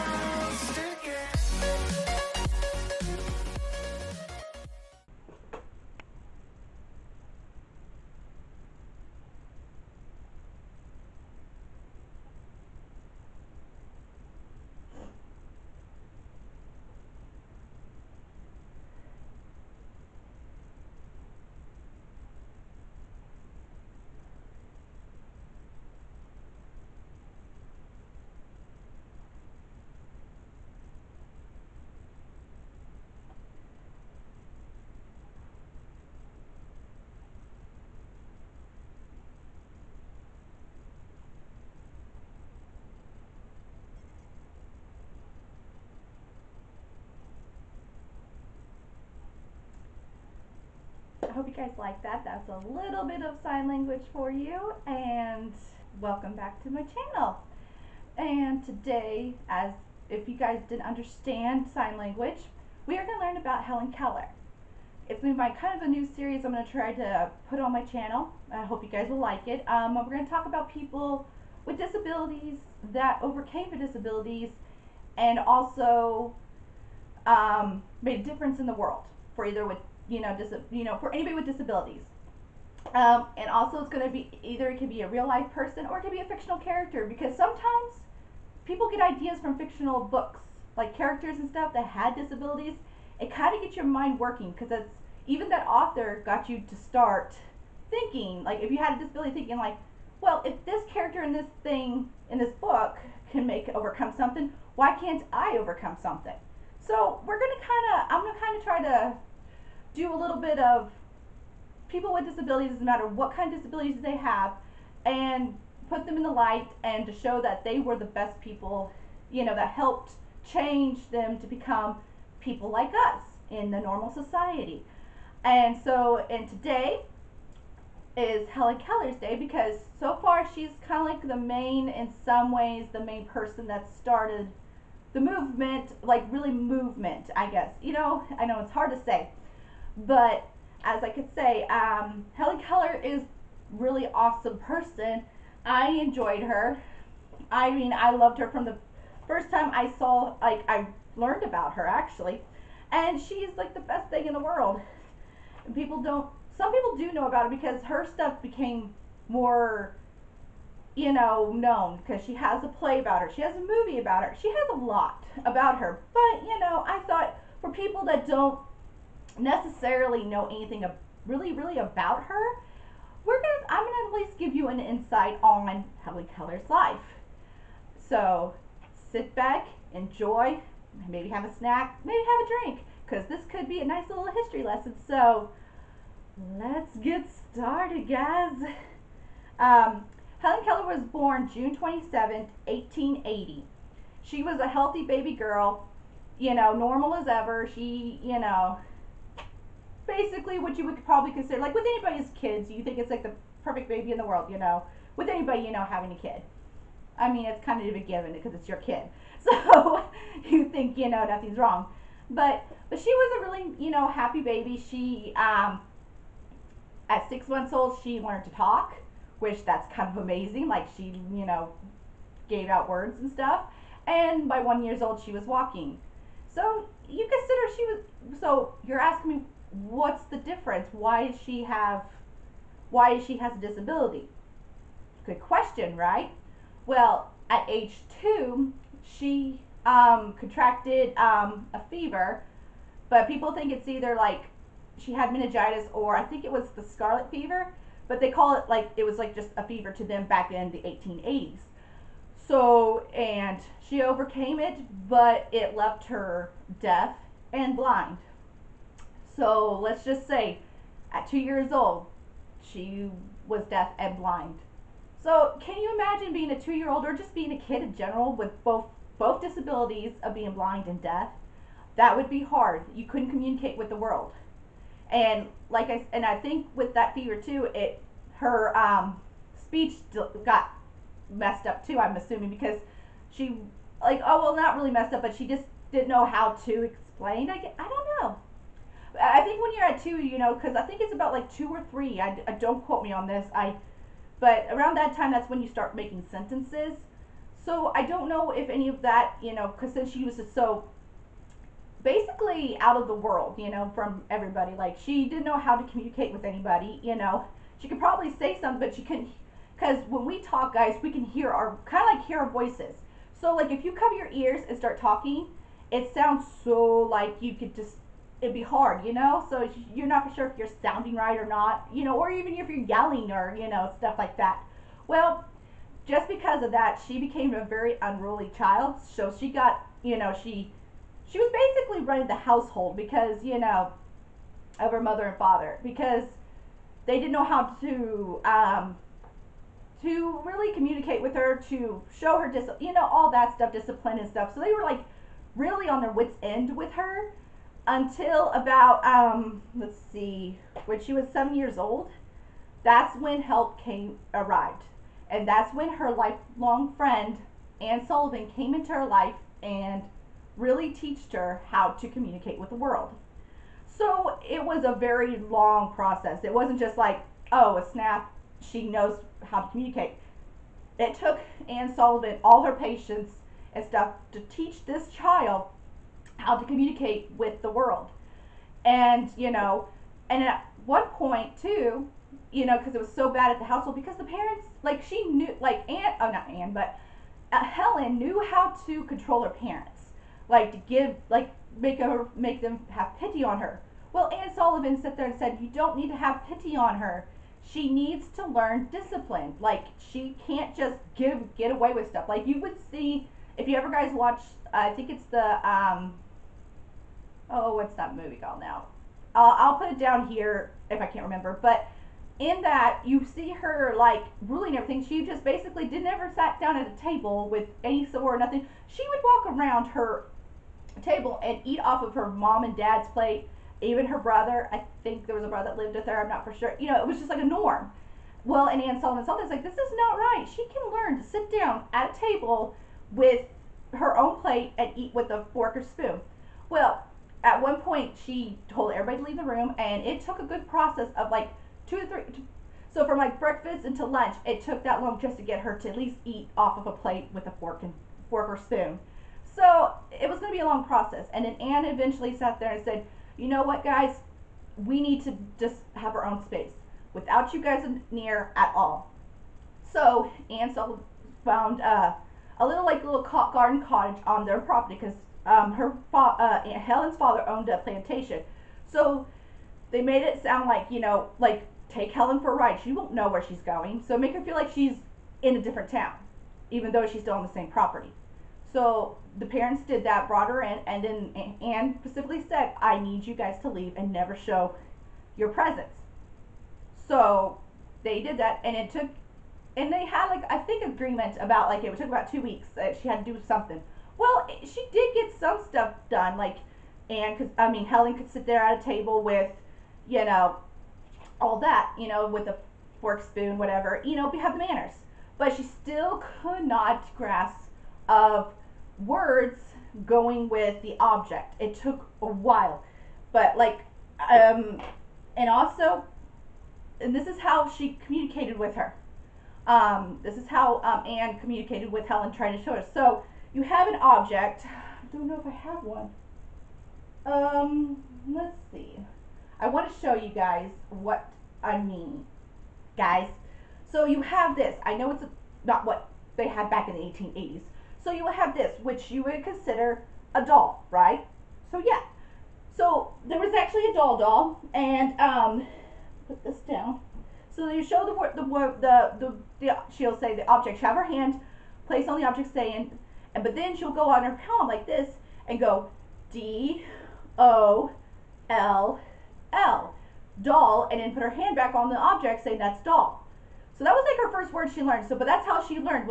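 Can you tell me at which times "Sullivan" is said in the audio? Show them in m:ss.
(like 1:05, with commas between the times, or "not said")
5:58, 6:11, 6:34, 7:08.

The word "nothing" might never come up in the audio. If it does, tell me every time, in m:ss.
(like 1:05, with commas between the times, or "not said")
3:31, 6:58.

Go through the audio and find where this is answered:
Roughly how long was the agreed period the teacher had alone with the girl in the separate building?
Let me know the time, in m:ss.
8:12.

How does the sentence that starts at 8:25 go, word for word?
But she still could not grasp of words going with the object.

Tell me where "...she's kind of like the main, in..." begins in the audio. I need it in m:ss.
2:10.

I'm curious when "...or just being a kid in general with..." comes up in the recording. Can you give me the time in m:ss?
4:27.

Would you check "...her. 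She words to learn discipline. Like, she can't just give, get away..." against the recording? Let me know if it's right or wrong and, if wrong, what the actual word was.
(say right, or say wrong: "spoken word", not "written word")
wrong: "needs", not "words".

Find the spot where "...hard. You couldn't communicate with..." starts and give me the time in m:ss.
4:32.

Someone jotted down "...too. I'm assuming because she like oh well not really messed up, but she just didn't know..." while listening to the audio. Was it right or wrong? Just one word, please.
right.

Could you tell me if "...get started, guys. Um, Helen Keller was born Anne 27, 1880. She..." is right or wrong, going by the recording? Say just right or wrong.
wrong.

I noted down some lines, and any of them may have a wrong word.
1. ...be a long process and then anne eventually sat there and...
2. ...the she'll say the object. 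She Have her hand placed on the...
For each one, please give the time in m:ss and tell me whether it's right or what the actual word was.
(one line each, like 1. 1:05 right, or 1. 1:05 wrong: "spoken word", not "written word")
1. 7:30 right
2. 9:09 right.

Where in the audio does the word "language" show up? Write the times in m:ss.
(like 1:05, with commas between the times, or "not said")
0:53, 1:01.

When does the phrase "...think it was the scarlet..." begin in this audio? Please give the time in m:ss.
4:06.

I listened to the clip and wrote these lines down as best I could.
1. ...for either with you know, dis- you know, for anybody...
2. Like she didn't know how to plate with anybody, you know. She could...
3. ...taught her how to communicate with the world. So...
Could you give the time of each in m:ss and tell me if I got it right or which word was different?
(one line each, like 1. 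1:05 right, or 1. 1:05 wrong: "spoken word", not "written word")
1. 1:19 right
2. 5:04 wrong: "communicate", not "plate"
3. 6:00 right.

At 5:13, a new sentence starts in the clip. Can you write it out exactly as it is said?
So like if you cover your ears and start talking, it sounds so like you could just it'd be hard, you know?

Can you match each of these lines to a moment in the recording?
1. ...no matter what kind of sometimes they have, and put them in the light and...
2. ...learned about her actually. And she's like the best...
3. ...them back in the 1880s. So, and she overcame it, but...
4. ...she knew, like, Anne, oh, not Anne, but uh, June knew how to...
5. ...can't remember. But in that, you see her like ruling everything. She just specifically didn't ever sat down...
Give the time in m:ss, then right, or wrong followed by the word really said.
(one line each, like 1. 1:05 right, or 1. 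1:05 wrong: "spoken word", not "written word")
1. 1:52 wrong: "disabilities", not "sometimes"
2. 2:31 right
3. 4:10 right
4. 6:25 wrong: "Helen", not "June"
5. 6:51 wrong: "basically", not "specifically".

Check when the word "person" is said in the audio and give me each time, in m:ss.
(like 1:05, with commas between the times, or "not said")
1:25, 2:13, 2:24.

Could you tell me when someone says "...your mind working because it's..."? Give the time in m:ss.
1:33.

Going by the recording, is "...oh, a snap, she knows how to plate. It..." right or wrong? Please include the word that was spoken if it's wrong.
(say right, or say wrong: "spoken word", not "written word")
wrong: "communicate", not "plate".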